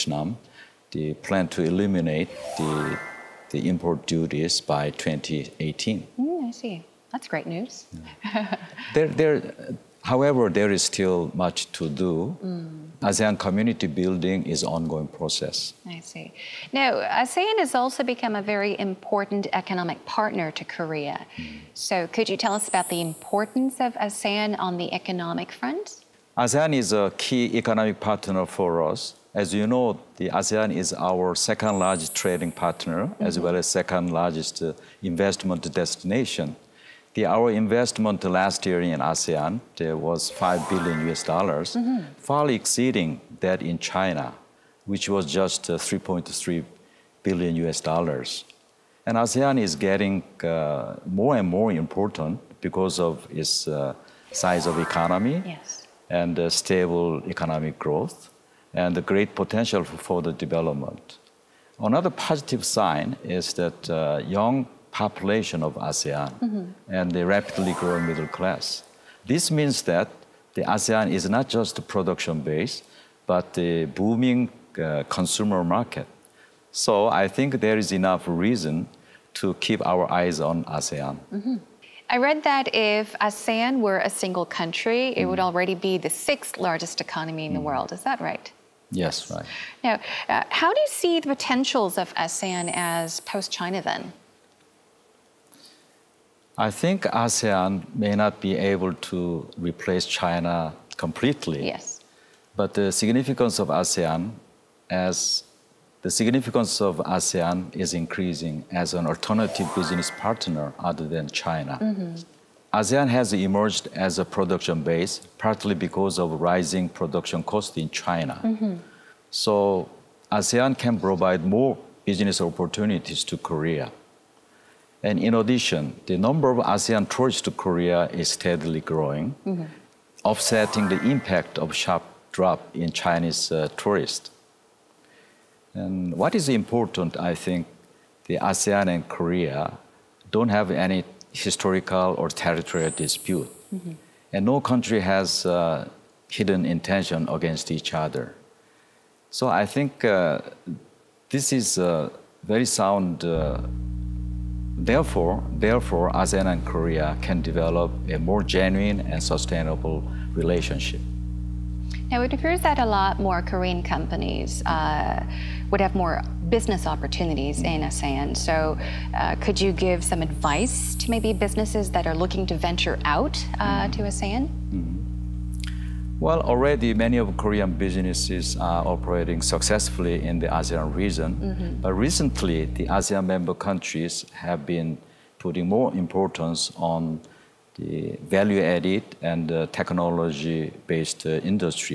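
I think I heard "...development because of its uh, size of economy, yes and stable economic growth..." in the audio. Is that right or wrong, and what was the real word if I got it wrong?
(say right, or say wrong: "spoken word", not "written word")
wrong: "important", not "development".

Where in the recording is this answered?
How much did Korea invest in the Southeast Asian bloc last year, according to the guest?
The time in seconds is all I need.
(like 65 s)
40 s.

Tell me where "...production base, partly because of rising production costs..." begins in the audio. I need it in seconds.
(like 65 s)
114 s.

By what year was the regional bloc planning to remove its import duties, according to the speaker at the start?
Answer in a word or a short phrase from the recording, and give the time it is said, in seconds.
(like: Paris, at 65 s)
2018, at 4 s.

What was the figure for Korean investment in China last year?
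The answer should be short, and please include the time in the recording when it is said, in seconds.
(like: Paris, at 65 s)
3.3 billion US dollars, at 45 s.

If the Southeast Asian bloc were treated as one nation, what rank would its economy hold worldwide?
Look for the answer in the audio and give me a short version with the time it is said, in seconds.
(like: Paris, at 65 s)
sixth largest, at 86 s.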